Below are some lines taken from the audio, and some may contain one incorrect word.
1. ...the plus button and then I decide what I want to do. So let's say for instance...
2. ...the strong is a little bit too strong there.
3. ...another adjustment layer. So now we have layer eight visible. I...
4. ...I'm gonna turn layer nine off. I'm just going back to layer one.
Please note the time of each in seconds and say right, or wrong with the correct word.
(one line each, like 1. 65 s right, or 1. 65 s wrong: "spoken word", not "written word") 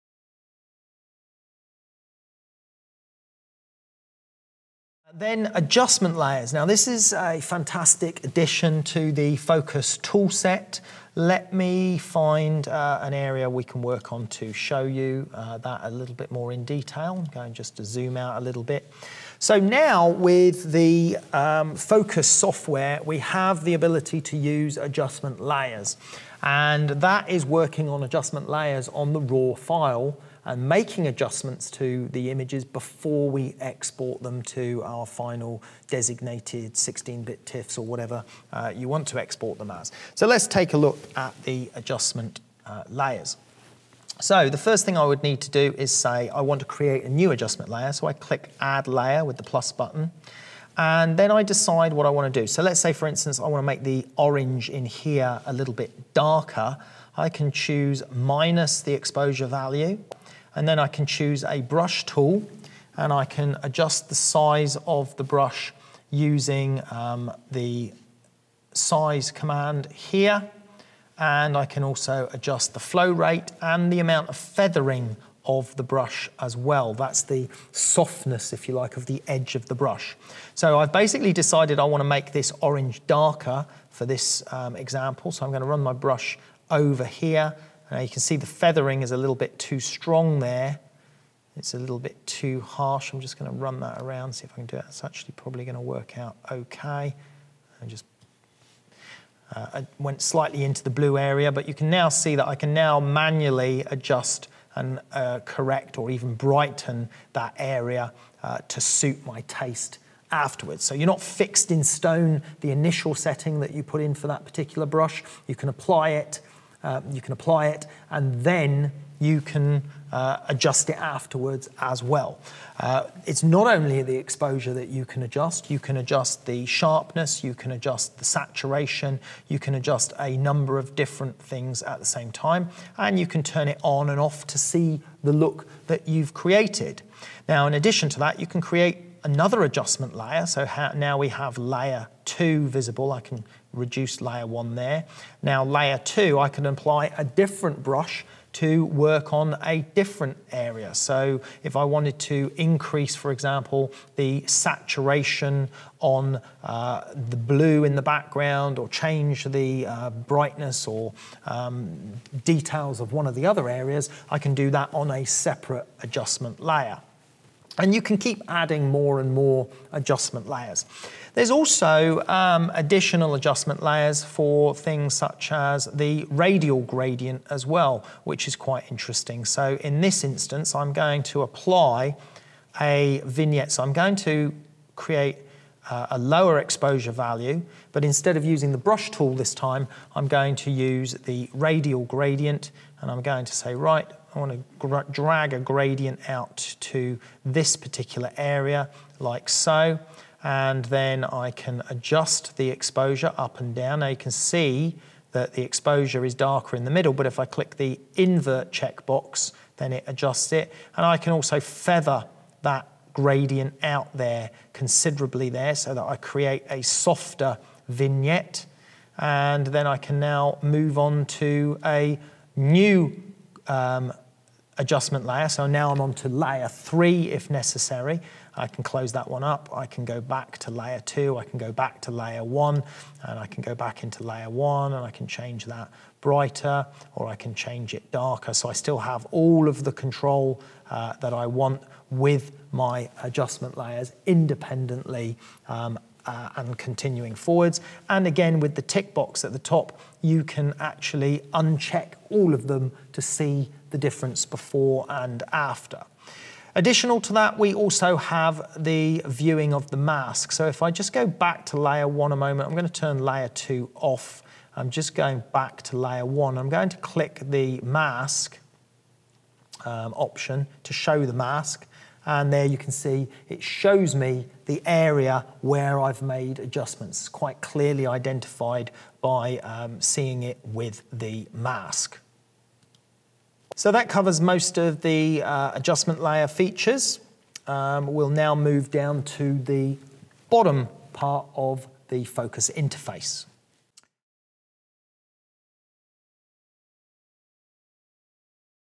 1. 49 s right
2. 88 s wrong: "feathering", not "strong"
3. 139 s wrong: "two", not "eight"
4. 262 s wrong: "two", not "nine".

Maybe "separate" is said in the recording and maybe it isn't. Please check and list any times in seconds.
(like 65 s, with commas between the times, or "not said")
165 s.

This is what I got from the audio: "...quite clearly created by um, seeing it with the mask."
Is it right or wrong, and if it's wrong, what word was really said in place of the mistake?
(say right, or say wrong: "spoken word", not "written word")
wrong: "identified", not "created".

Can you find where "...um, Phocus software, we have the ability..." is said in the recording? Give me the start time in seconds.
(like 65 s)
21 s.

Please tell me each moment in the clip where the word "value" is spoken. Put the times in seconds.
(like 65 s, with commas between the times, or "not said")
59 s, 187 s.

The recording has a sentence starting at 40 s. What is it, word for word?
So let's take a look at the adjustment uh, layers.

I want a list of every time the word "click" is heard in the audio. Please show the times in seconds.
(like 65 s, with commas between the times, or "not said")
48 s, 207 s, 266 s.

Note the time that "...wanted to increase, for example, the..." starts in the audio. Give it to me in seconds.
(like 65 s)
151 s.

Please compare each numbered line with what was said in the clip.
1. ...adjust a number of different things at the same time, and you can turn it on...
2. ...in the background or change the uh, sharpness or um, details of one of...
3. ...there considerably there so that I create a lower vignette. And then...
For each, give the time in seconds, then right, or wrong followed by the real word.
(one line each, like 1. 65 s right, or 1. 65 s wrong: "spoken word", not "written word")
1. 129 s right
2. 157 s wrong: "brightness", not "sharpness"
3. 214 s wrong: "softer", not "lower".